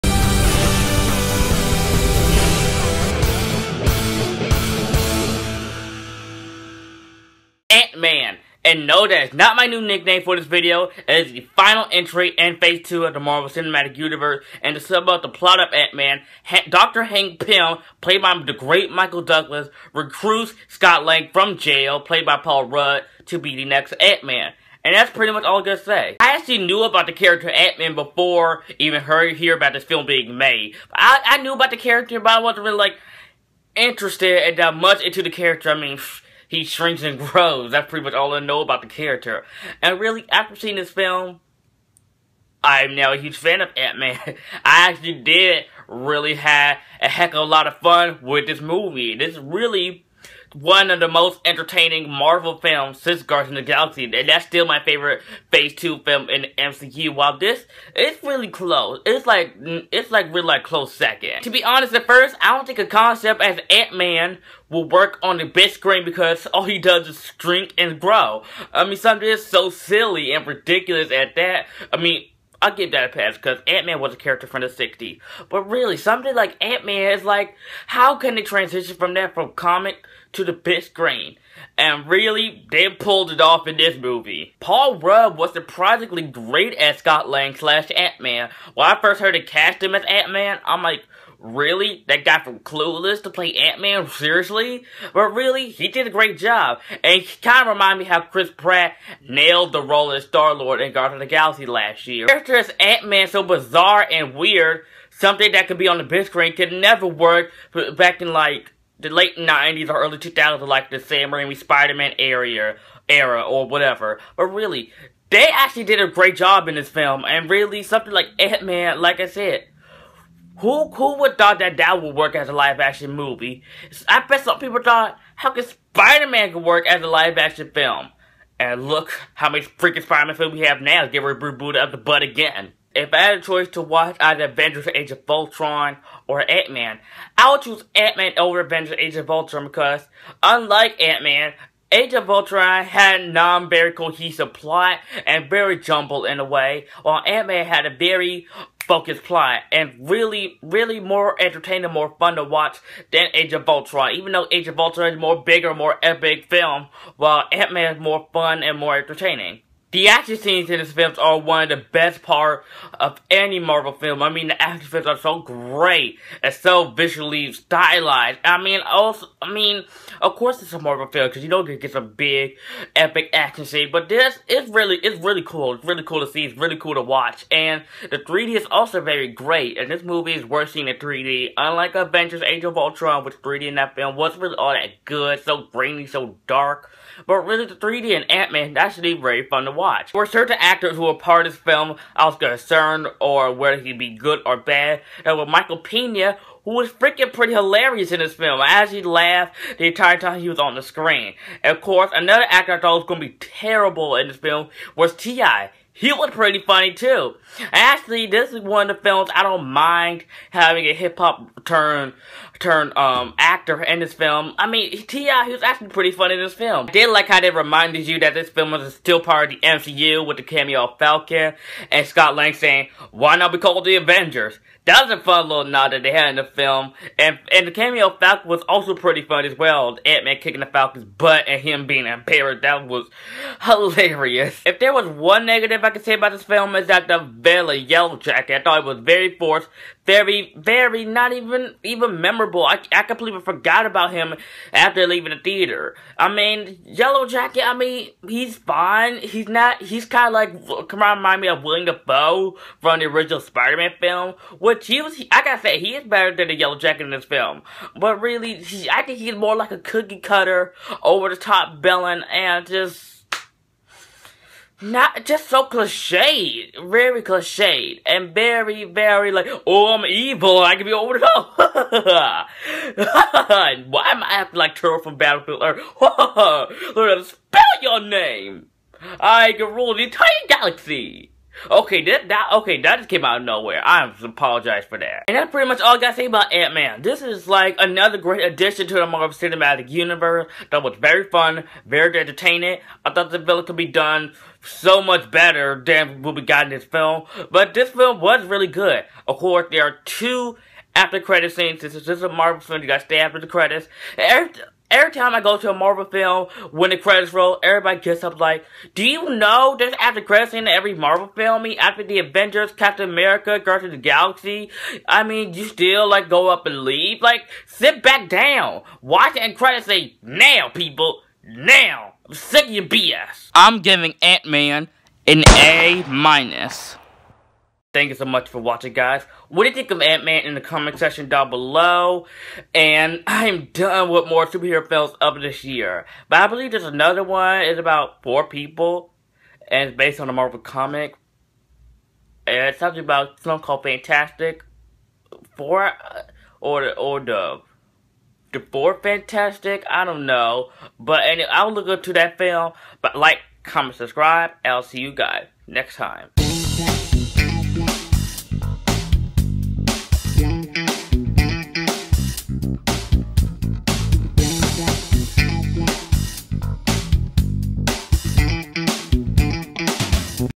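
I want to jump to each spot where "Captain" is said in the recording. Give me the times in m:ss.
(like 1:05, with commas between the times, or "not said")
5:12.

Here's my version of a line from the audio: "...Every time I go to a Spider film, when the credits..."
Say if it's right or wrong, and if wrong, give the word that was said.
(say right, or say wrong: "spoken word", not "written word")
wrong: "Marvel", not "Spider".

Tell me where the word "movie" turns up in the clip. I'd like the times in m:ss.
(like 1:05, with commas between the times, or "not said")
0:48, 1:23, 2:03, 3:00.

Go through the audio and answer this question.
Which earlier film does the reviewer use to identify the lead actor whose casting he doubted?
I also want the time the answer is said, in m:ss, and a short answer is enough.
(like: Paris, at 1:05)
Clueless, at 1:32.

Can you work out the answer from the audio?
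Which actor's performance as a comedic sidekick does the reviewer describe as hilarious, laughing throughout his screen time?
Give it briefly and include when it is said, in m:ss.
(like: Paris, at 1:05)
Michael Pena, at 3:15.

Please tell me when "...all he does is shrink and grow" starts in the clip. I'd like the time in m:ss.
1:06.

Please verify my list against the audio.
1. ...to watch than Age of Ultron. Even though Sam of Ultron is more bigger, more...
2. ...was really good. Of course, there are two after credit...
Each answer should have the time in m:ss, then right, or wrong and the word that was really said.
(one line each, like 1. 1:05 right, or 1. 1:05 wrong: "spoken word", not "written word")
1. 2:32 wrong: "Age", not "Sam"
2. 4:58 right.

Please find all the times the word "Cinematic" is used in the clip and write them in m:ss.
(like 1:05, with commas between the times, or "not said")
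0:13, 4:49.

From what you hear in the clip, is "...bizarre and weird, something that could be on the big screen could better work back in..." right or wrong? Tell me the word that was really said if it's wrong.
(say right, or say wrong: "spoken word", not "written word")
wrong: "never", not "better".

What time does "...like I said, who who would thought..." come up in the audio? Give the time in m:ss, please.
1:59.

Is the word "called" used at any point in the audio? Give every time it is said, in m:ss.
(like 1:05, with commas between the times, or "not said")
3:43, 5:43.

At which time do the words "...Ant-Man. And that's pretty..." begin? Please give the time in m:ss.
0:23.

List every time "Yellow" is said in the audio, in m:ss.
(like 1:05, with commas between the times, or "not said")
3:57, 4:06, 4:16.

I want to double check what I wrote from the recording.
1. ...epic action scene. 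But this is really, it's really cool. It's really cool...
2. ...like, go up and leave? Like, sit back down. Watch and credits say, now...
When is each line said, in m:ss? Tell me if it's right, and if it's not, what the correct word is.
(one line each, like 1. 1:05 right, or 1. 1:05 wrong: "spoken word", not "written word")
1. 2:52 right
2. 5:16 right.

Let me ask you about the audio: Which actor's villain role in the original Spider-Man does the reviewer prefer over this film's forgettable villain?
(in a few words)
William Dafoe.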